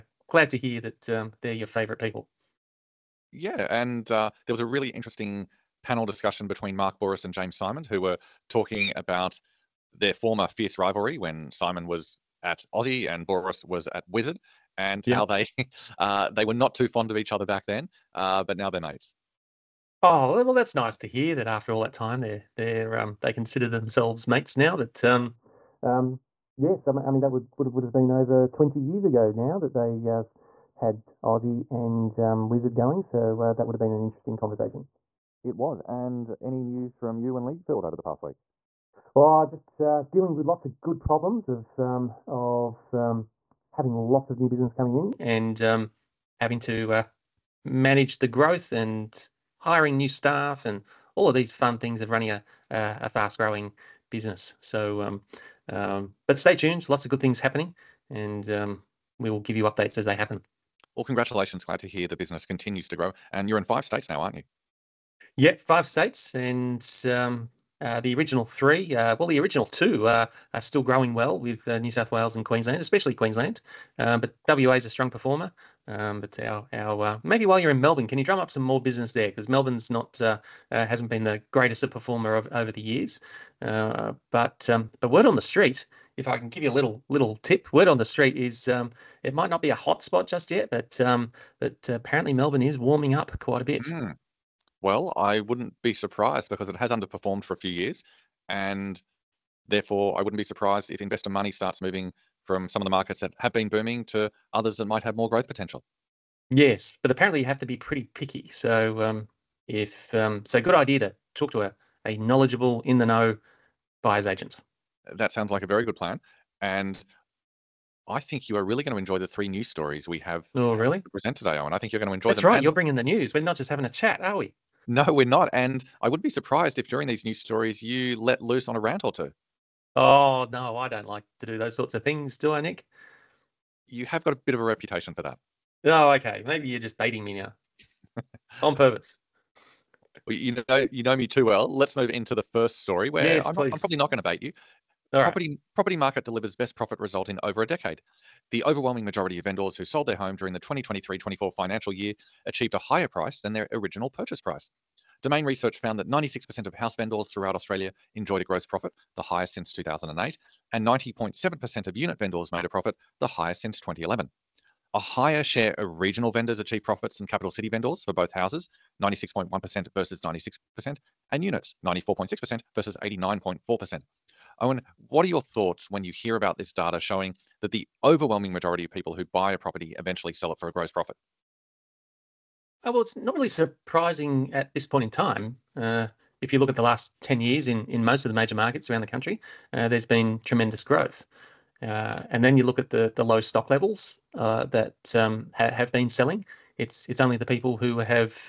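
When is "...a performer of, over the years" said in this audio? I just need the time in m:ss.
1:21.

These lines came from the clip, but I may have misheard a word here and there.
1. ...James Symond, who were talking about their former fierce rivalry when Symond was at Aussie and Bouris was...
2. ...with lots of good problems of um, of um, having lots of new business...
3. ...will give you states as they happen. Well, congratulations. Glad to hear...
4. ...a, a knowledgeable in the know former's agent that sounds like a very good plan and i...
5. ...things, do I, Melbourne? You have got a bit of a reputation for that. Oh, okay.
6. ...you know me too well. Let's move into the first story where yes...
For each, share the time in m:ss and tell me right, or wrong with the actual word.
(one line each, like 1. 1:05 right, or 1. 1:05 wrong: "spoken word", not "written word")
1. 0:07 right
2. 0:40 right
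3. 0:59 wrong: "updates", not "states"
4. 1:51 wrong: "buyer", not "former"
5. 2:12 wrong: "Nick", not "Melbourne"
6. 2:20 right.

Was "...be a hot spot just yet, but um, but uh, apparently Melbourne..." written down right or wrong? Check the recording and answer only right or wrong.
right.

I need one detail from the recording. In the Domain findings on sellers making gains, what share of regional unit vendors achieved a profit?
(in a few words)
94.6%.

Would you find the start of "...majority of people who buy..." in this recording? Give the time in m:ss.
2:58.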